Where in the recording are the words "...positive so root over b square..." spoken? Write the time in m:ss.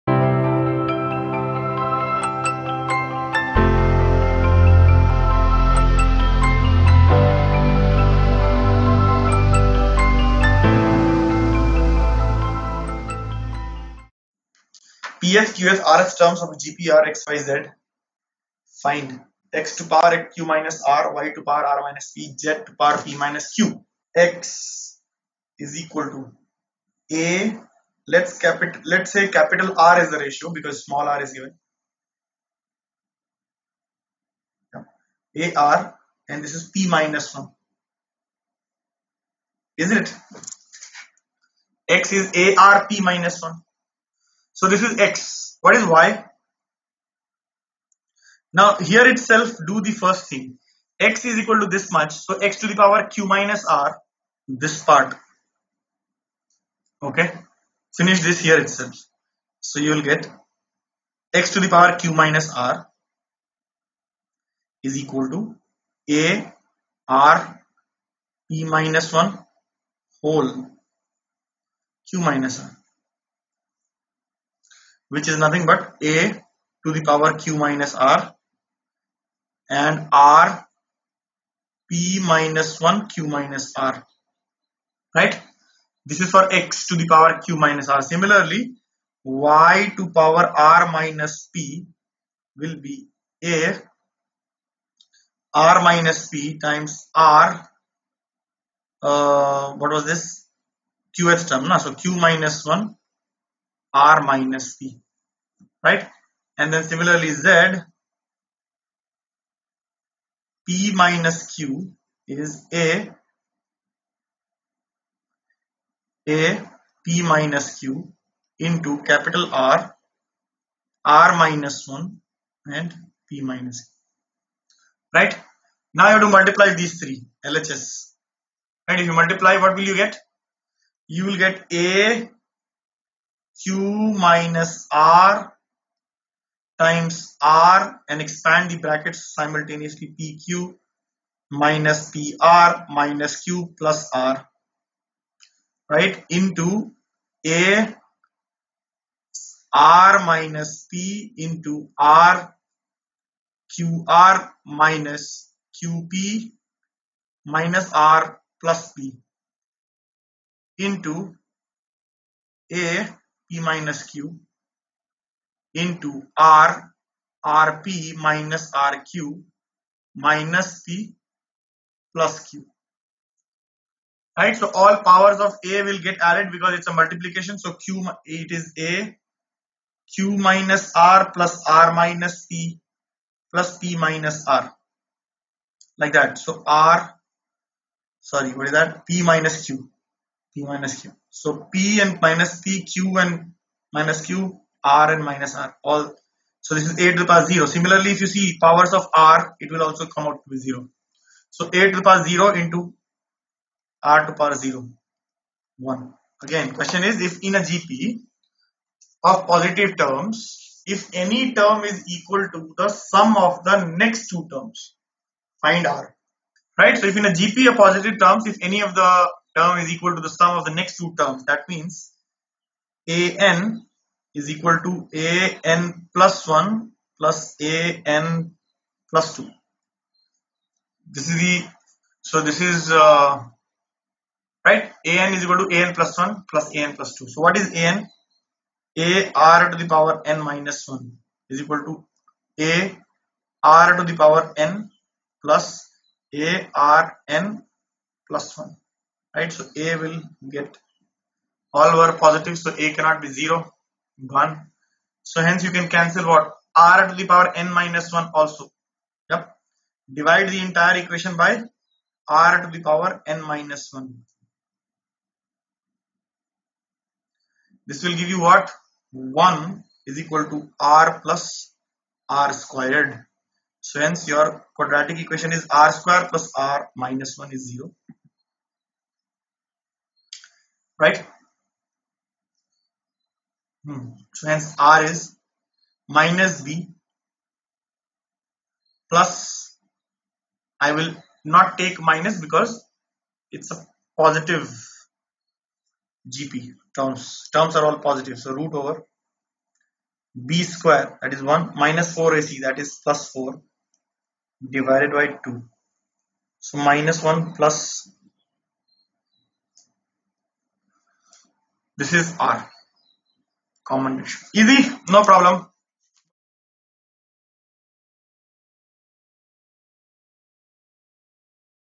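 4:58.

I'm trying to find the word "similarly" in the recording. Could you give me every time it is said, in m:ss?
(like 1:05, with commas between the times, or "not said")
1:28, 1:46, 3:17.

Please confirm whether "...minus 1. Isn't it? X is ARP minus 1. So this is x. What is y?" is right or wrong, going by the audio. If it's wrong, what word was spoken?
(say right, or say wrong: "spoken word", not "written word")
right.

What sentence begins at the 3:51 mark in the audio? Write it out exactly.
This is the, so this is, uh, right, an is equal to an plus 1 plus an plus 2.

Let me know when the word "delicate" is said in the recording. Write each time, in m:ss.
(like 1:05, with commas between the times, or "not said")
not said.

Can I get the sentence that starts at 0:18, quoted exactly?
Find x to power q minus r, y to power r minus p, z to power p minus q.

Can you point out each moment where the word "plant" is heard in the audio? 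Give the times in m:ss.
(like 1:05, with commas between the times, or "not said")
not said.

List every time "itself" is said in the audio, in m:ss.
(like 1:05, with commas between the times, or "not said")
0:49, 0:58.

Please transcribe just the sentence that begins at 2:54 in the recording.
Right, so all powers of A will get added because it's a multiplication.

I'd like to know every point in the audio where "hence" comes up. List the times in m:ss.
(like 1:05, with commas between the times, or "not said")
4:15, 4:34, 4:44.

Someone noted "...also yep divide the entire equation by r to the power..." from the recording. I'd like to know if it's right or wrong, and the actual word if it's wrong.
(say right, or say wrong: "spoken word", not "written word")
right.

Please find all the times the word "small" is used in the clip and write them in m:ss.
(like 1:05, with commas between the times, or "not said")
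0:30.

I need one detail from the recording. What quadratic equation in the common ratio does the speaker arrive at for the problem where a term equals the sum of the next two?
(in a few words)
r² + r − 1 = 0.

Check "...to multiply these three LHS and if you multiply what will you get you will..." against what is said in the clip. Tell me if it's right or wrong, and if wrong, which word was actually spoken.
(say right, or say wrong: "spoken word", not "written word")
right.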